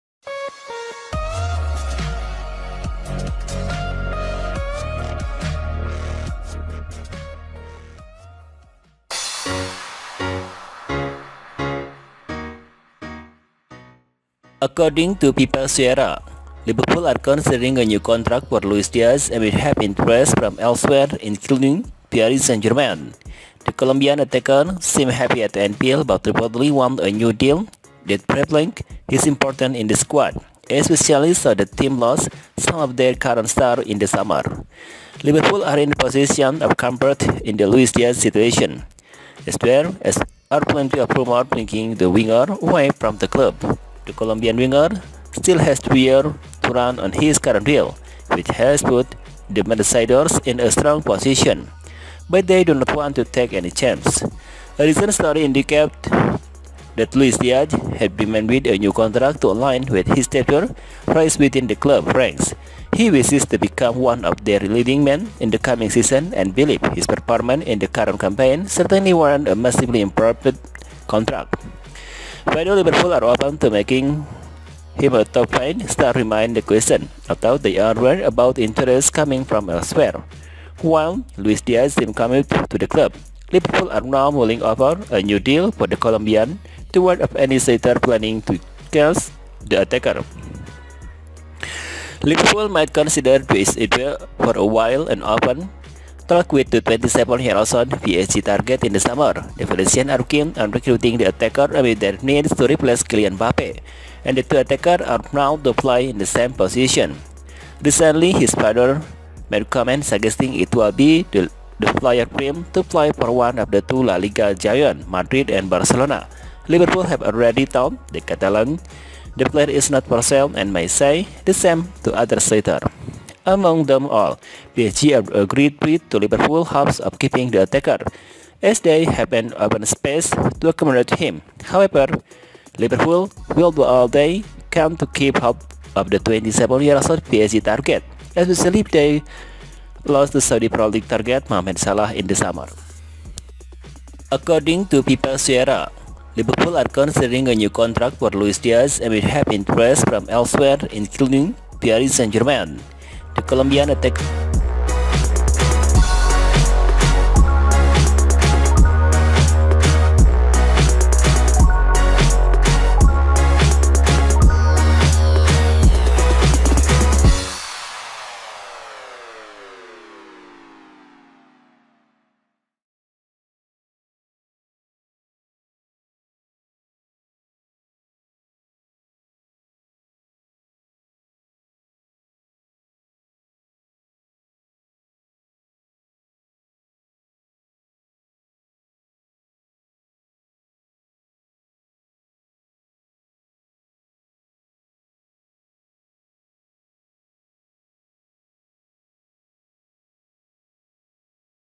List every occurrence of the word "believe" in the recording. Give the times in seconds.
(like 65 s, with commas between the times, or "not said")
66 s.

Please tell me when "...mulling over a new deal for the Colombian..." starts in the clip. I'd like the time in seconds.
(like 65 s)
84 s.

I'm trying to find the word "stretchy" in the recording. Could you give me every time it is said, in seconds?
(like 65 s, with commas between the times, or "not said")
not said.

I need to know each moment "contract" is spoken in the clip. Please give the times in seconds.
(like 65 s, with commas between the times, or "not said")
17 s, 58 s, 71 s, 147 s.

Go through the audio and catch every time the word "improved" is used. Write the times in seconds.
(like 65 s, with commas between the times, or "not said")
70 s.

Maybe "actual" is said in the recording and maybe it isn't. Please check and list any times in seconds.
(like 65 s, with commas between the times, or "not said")
not said.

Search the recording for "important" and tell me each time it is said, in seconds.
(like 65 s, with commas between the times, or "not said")
29 s.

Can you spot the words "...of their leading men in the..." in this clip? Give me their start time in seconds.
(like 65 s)
64 s.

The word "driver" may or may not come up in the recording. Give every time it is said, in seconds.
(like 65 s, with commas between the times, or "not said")
not said.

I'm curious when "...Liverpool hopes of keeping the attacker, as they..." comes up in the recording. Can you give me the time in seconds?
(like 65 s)
126 s.